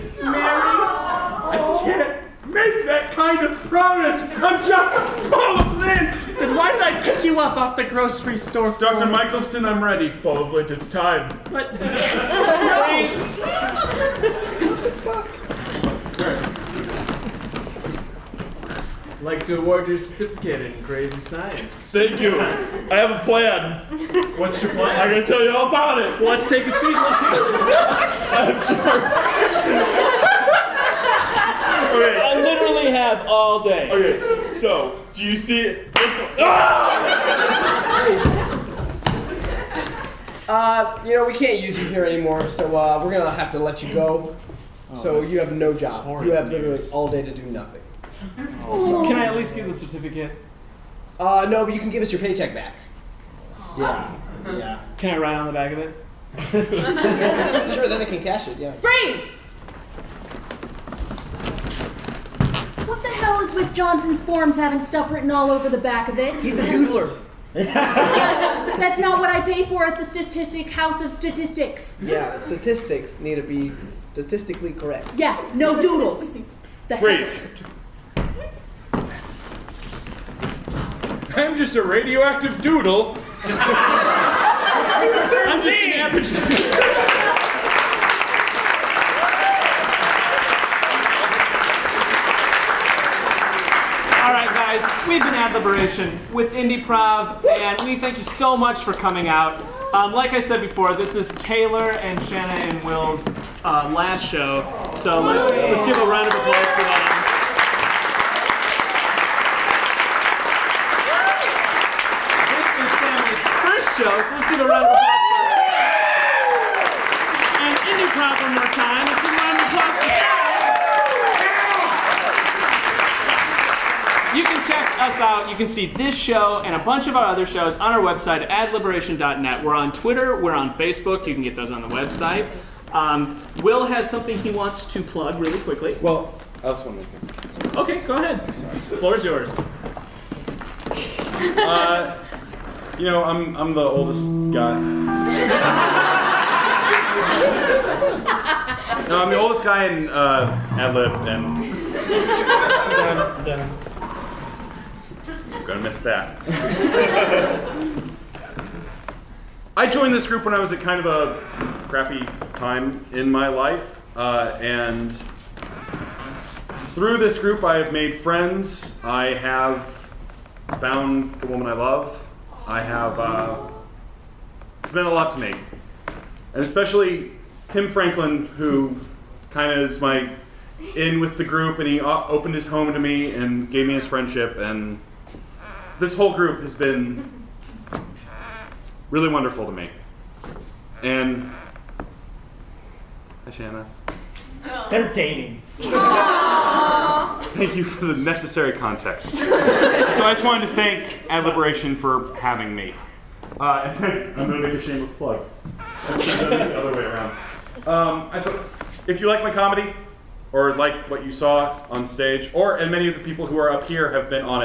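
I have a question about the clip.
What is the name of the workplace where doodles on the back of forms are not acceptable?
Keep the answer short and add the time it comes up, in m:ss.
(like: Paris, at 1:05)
Statistic House of Statistics, at 1:10.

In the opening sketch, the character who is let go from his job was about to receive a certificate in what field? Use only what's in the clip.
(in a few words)
crazy science.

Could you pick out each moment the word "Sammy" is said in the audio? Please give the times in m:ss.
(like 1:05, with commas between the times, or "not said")
1:52.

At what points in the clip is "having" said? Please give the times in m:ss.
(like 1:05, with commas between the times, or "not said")
1:04, 3:22.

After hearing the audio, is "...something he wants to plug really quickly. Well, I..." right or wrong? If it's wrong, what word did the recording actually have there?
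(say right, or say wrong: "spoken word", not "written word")
right.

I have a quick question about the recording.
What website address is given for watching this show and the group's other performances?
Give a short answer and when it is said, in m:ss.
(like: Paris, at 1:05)
adliberation.net, at 2:08.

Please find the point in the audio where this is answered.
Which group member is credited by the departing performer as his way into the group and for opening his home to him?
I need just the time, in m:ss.
2:57.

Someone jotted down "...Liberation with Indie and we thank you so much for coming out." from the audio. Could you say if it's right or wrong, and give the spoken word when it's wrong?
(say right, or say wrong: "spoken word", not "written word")
right.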